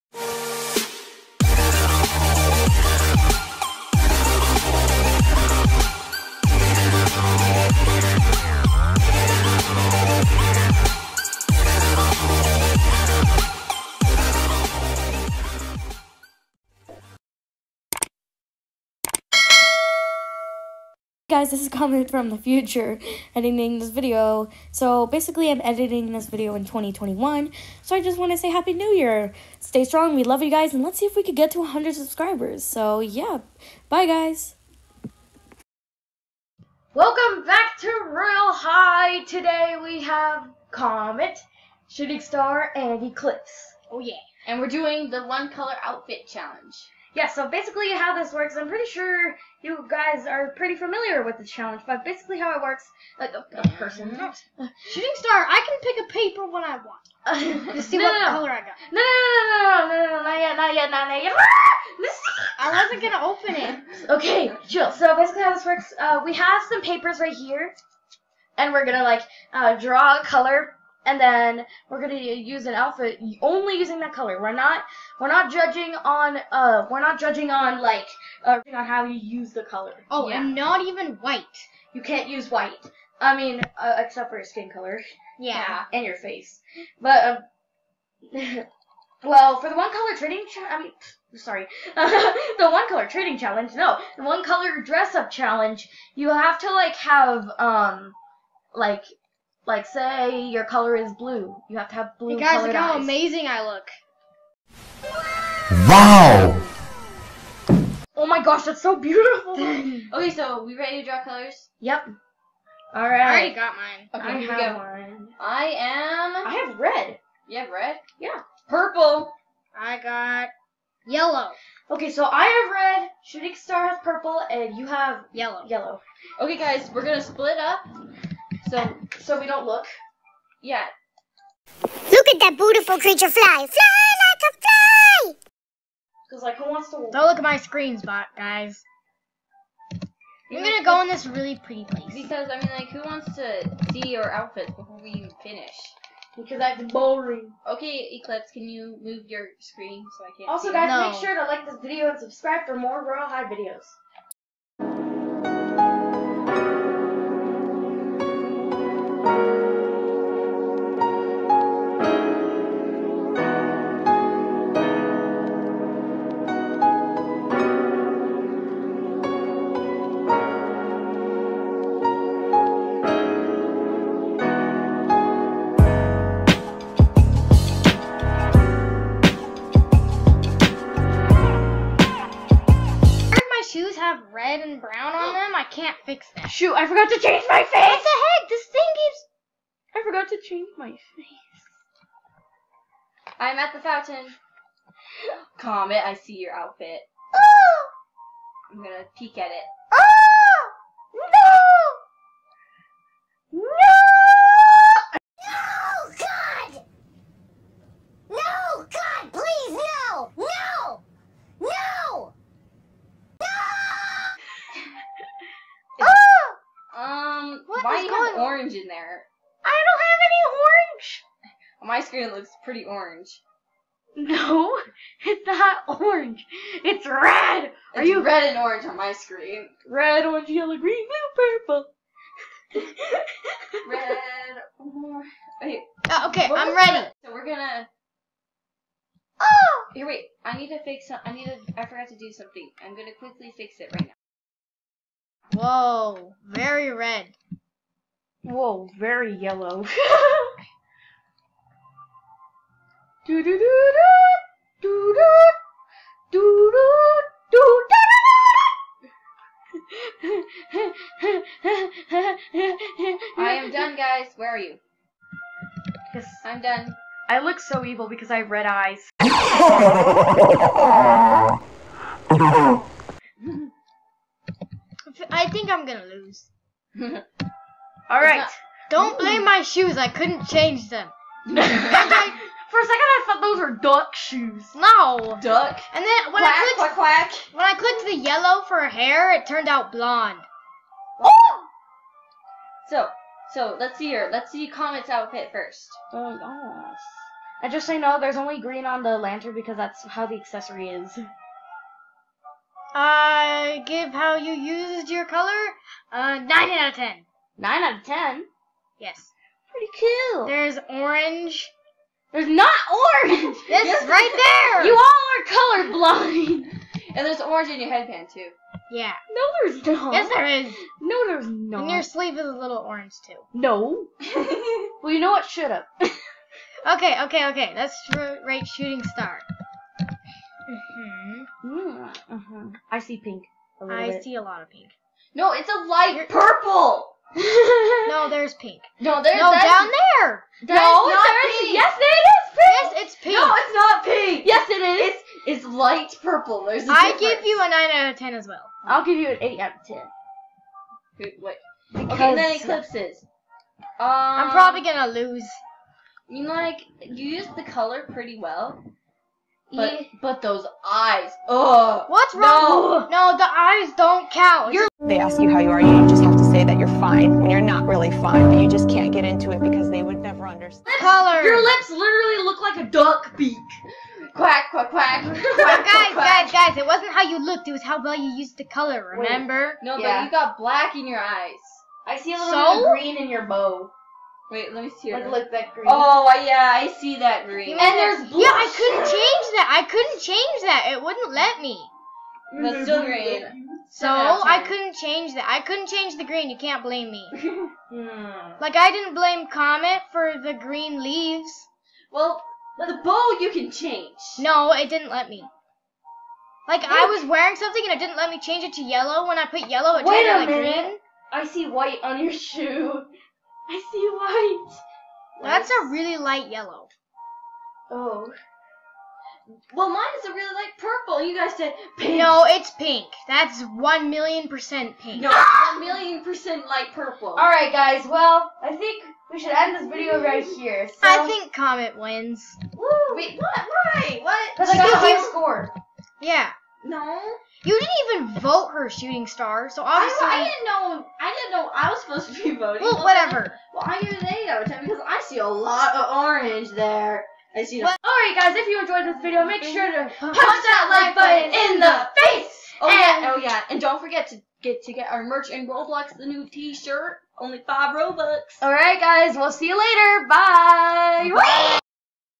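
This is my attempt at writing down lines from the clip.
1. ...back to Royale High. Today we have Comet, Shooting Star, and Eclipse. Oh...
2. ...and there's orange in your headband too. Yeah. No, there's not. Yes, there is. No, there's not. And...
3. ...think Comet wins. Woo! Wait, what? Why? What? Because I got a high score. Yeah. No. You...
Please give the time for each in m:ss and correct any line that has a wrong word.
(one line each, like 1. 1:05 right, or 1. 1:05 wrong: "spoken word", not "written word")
1. 0:37 right
2. 5:17 right
3. 7:11 right.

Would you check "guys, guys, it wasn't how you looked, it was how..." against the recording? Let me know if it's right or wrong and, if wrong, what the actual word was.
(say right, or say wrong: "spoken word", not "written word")
right.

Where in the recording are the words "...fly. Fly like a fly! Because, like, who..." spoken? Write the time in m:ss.
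2:13.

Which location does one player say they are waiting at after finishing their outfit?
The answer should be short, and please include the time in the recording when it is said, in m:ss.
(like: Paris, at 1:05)
The fountain, at 3:13.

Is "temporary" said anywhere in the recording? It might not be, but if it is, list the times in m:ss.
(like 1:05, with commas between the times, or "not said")
not said.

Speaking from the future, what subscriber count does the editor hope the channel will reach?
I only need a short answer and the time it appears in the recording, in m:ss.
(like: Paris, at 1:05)
100, at 0:31.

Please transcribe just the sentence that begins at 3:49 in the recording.
Red, orange, yellow, green, blue, purple.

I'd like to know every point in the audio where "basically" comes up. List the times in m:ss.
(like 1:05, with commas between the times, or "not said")
0:25, 0:47, 0:52, 1:05.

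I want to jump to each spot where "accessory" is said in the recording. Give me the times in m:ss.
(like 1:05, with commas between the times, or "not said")
5:00.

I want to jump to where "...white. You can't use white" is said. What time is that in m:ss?
1:21.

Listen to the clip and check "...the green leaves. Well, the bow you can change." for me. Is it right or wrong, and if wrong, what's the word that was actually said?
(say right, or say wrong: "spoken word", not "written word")
right.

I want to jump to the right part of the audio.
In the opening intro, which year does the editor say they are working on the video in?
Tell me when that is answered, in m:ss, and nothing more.
0:26.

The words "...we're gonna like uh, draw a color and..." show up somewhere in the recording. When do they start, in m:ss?
1:08.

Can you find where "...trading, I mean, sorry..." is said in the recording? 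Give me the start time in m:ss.
1:30.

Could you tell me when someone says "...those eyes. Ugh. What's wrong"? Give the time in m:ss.
6:00.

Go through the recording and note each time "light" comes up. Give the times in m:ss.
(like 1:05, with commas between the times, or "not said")
5:35, 5:45, 6:56, 7:00, 7:06.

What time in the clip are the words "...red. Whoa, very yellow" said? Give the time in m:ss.
4:06.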